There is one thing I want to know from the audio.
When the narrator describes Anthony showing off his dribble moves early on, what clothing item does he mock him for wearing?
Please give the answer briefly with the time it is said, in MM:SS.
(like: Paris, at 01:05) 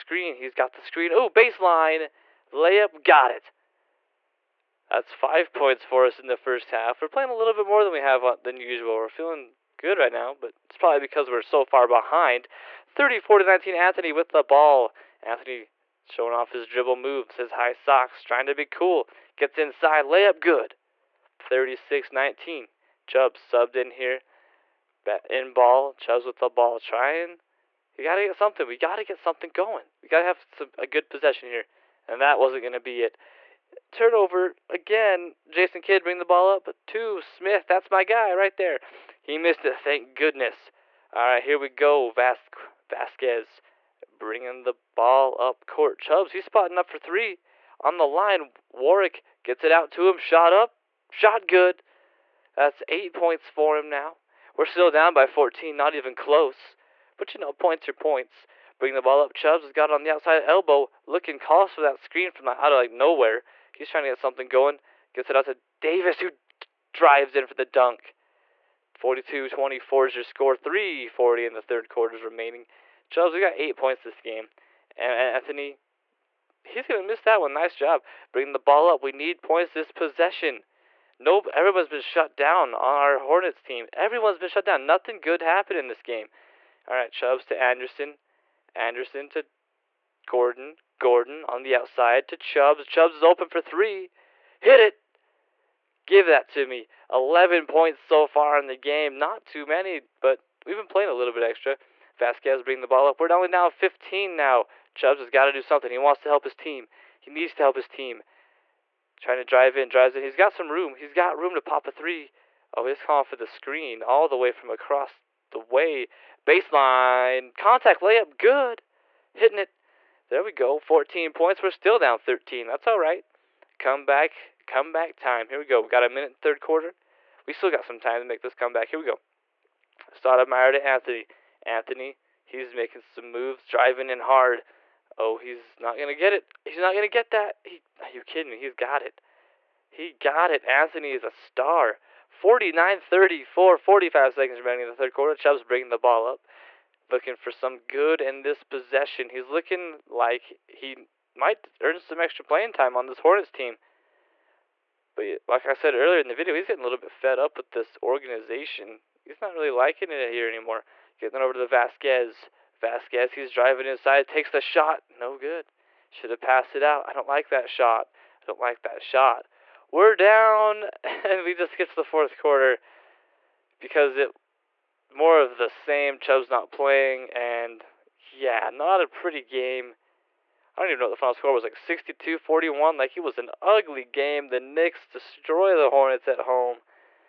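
High socks, at 00:17.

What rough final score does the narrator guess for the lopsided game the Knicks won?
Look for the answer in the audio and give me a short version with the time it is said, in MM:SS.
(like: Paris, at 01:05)
62-41, at 03:01.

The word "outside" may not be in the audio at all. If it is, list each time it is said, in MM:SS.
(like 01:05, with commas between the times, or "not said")
01:00, 01:31.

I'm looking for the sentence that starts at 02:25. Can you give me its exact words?
Chubb's bringing the ball up, looking for some good in this possession.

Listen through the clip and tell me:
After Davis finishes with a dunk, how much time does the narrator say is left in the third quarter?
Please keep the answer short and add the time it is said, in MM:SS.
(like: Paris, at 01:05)
3:40, at 01:10.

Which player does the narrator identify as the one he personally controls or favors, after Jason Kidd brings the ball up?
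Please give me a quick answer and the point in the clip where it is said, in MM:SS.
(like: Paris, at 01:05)
Smith, at 00:37.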